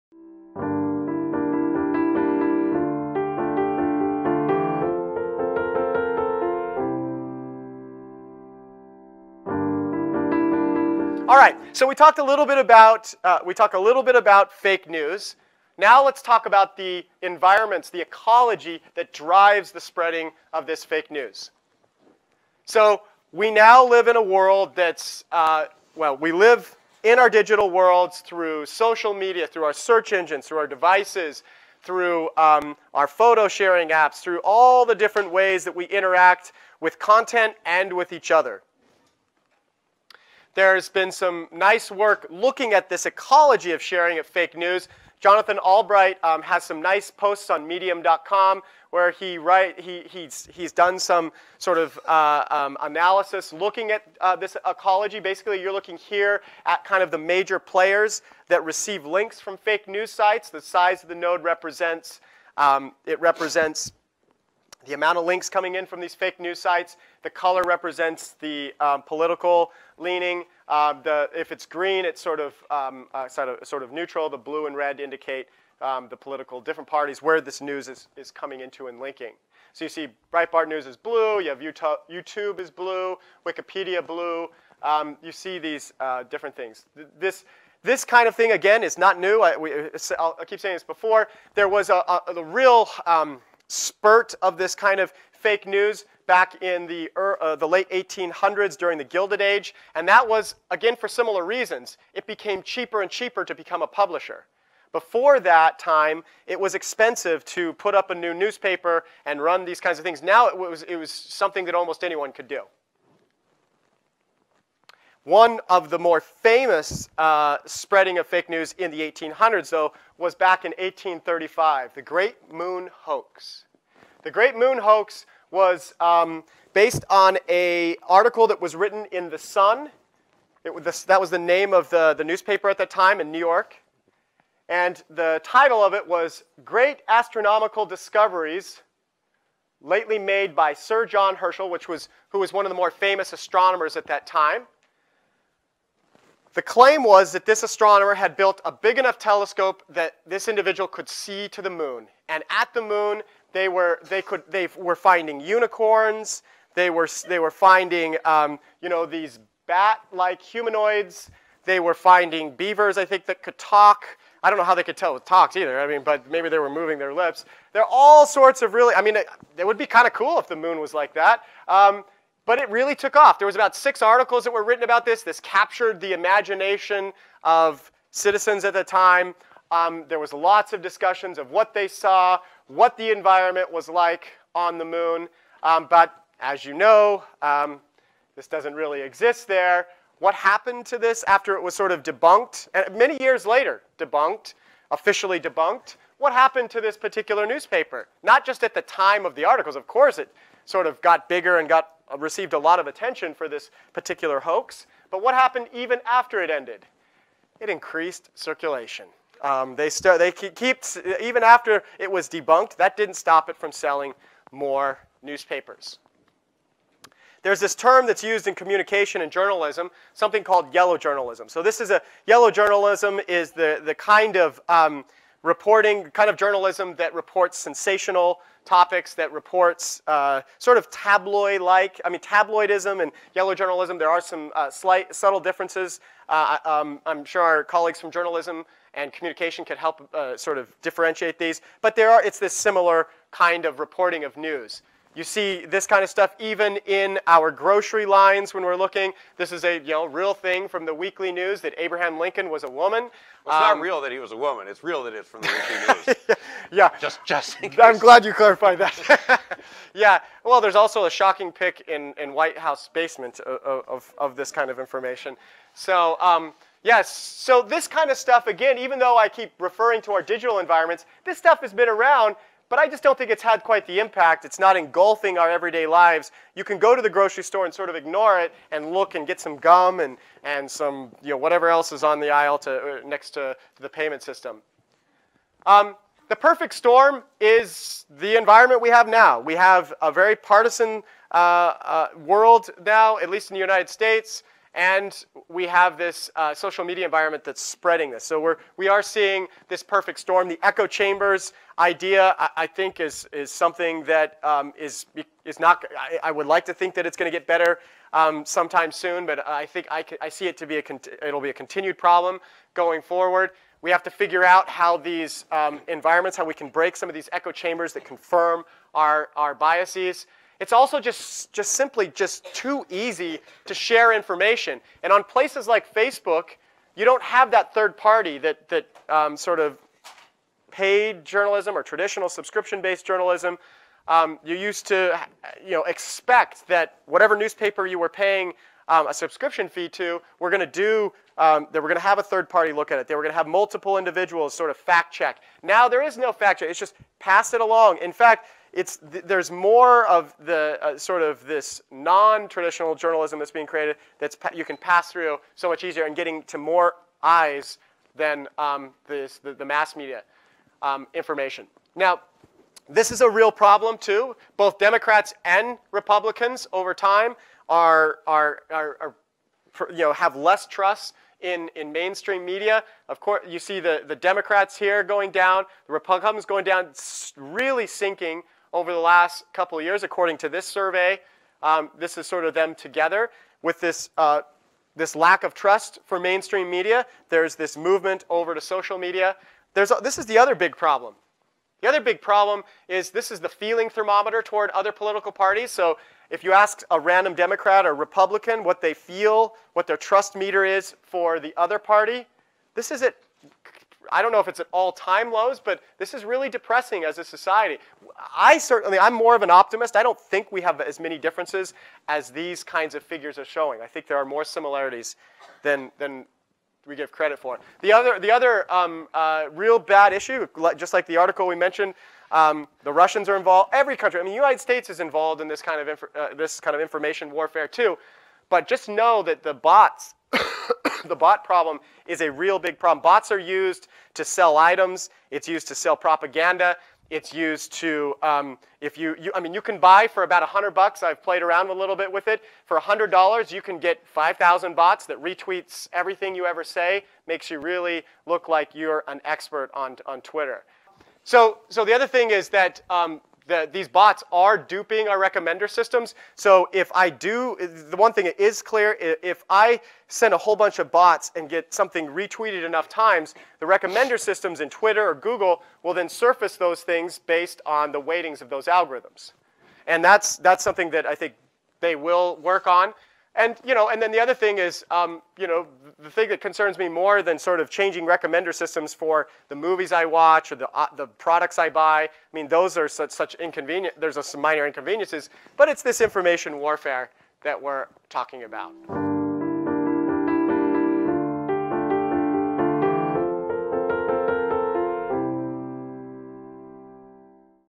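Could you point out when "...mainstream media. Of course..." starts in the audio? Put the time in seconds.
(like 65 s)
371 s.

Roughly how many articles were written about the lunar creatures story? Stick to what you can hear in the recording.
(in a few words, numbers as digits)
6.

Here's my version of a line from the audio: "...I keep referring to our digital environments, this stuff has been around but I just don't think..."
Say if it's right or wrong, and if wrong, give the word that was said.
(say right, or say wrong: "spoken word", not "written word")
right.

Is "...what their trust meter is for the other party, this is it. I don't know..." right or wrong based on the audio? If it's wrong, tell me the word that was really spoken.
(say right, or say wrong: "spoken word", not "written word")
right.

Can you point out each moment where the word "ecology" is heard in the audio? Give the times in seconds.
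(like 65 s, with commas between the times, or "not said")
18 s, 43 s, 54 s.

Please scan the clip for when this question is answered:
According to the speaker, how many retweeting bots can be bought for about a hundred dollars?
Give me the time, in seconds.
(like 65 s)
444 s.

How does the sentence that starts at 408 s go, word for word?
I certainly, I'm more of an optimist.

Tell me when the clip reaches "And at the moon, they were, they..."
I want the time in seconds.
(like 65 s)
152 s.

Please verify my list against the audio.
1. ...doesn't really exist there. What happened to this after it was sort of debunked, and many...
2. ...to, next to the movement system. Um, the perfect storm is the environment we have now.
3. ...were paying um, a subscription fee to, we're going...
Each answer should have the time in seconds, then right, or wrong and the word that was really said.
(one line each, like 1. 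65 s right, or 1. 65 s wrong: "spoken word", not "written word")
1. 188 s right
2. 282 s wrong: "payment", not "movement"
3. 337 s right.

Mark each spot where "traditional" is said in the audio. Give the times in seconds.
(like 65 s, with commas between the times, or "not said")
331 s, 351 s.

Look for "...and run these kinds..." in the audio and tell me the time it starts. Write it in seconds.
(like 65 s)
109 s.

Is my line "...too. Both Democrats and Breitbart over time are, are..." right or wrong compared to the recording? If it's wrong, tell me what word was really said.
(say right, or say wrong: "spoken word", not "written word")
wrong: "Republicans", not "Breitbart".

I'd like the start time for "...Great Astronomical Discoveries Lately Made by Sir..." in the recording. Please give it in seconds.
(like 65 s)
136 s.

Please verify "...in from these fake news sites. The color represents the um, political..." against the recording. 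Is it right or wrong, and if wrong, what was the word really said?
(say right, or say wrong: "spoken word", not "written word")
right.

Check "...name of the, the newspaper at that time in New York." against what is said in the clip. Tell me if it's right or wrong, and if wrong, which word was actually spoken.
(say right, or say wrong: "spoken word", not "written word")
right.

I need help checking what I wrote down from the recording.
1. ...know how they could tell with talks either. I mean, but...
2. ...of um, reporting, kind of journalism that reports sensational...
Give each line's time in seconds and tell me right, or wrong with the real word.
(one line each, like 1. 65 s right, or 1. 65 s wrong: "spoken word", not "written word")
1. 164 s right
2. 224 s right.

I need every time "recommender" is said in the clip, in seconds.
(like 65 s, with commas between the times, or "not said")
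455 s, 463 s, 478 s.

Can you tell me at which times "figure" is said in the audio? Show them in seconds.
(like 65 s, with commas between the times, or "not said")
314 s, 413 s.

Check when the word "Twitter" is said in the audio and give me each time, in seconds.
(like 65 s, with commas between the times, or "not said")
450 s, 464 s.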